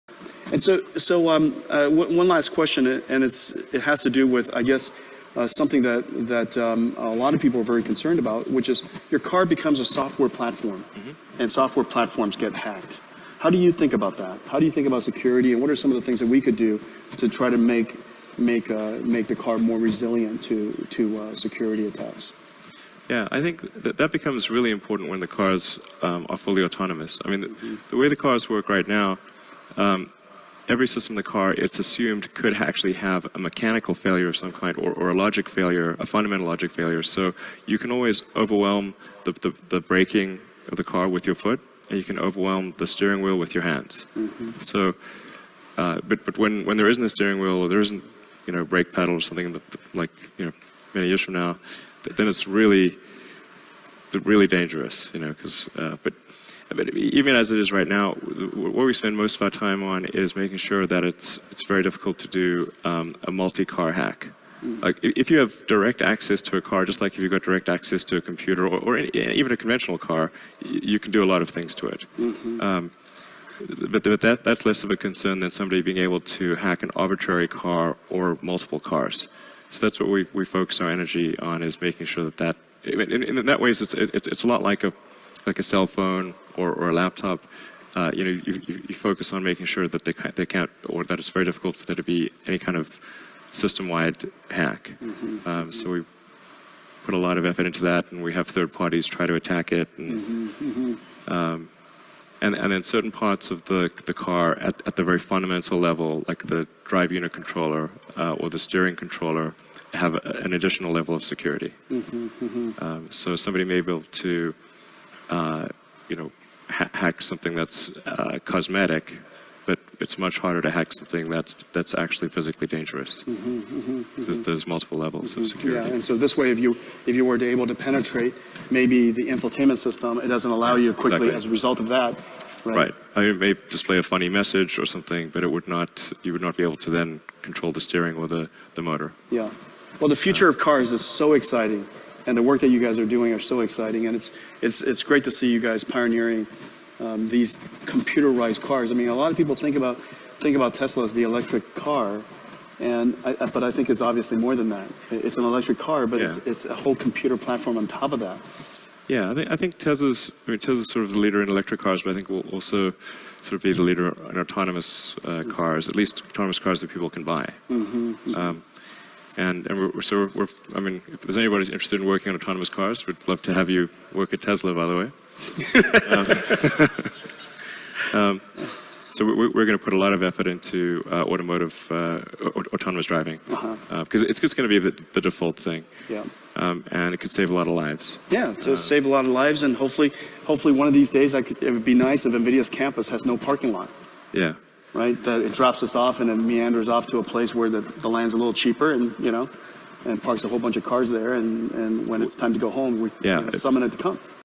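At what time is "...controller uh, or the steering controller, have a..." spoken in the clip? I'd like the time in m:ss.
1:47.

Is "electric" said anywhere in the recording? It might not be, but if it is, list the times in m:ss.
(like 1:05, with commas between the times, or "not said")
2:31, 2:35, 2:41.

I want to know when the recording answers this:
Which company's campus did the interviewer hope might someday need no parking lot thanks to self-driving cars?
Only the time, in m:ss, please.
3:12.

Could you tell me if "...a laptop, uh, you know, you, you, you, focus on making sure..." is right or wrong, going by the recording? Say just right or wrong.
right.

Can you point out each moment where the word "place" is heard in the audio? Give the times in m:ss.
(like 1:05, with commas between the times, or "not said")
3:17.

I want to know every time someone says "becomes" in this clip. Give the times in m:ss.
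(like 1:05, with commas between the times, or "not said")
0:09, 0:24.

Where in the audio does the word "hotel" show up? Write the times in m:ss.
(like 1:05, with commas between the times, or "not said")
not said.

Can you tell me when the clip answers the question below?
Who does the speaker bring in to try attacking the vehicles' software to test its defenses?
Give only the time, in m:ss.
1:38.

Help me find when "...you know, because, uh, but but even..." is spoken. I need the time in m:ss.
0:55.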